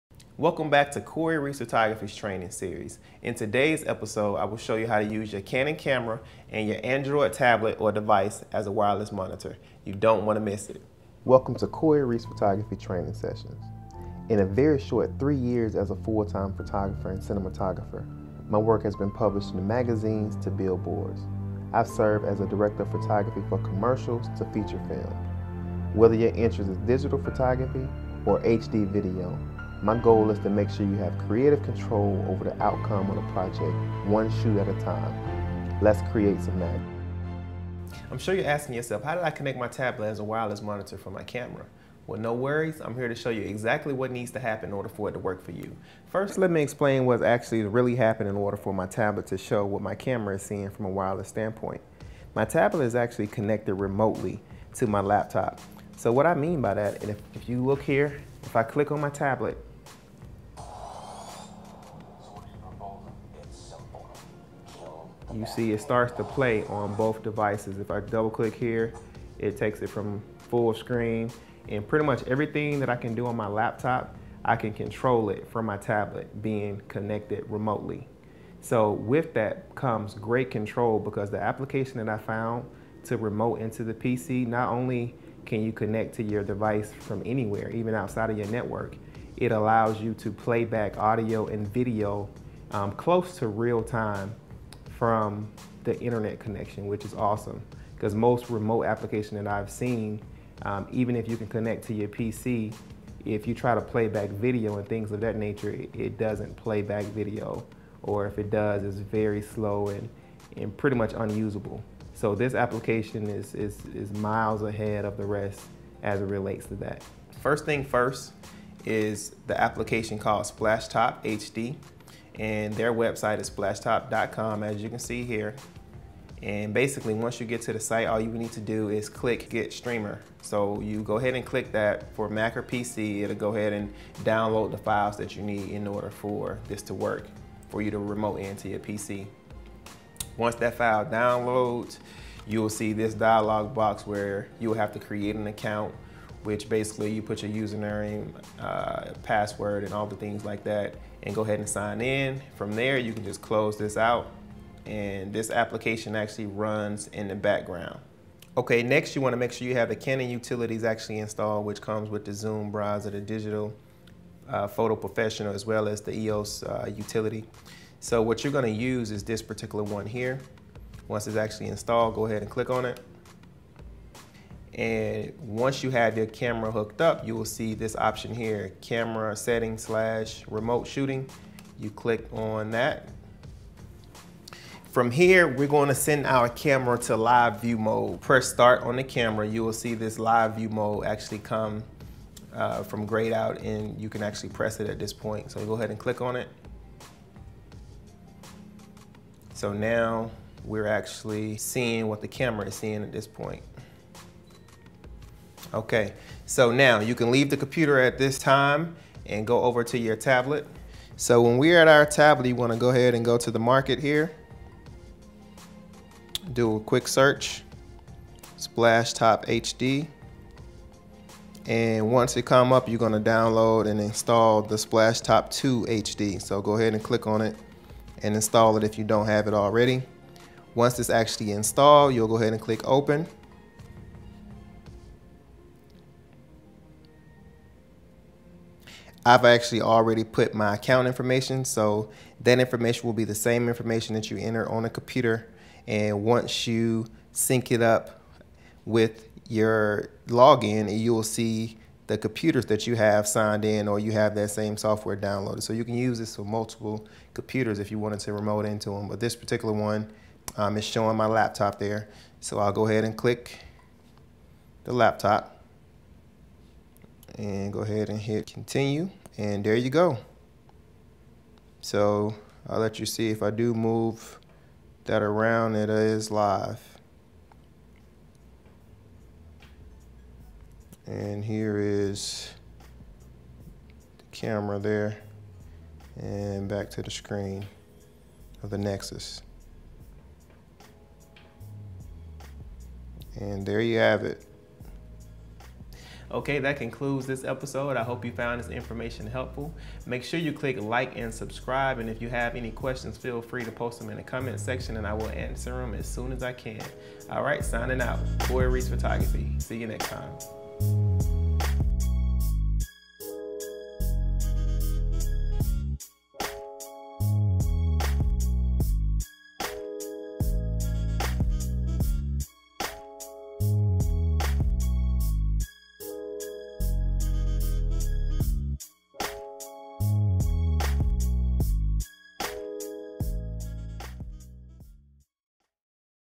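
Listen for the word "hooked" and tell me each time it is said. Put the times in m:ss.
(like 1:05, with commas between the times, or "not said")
2:56.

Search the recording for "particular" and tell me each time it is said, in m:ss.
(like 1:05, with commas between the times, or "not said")
2:49, 4:19.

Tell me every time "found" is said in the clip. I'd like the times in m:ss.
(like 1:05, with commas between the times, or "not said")
1:22, 4:58.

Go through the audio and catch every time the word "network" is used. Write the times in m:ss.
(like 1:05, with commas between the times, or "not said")
1:28.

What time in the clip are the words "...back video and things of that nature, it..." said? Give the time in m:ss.
1:44.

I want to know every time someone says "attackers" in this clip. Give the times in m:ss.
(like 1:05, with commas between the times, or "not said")
not said.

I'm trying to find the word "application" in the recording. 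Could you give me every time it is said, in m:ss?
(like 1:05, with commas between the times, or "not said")
1:21, 1:38, 1:52, 1:59, 2:35.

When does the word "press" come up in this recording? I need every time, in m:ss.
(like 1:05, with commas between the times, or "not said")
3:08, 3:14.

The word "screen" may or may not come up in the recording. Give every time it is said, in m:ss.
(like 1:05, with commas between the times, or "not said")
1:10, 4:47.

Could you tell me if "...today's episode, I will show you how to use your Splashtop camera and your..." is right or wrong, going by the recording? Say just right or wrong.
wrong.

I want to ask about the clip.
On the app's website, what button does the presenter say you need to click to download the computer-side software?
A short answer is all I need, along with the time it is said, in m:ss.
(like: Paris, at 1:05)
get streamer, at 2:09.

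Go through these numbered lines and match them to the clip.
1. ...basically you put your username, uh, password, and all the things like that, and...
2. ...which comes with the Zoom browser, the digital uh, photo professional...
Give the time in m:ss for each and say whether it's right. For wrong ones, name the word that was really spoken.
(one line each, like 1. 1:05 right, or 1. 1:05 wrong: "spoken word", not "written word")
1. 2:26 right
2. 2:41 right.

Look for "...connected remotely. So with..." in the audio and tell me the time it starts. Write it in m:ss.
1:16.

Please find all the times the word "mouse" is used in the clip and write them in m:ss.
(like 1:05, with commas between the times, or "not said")
not said.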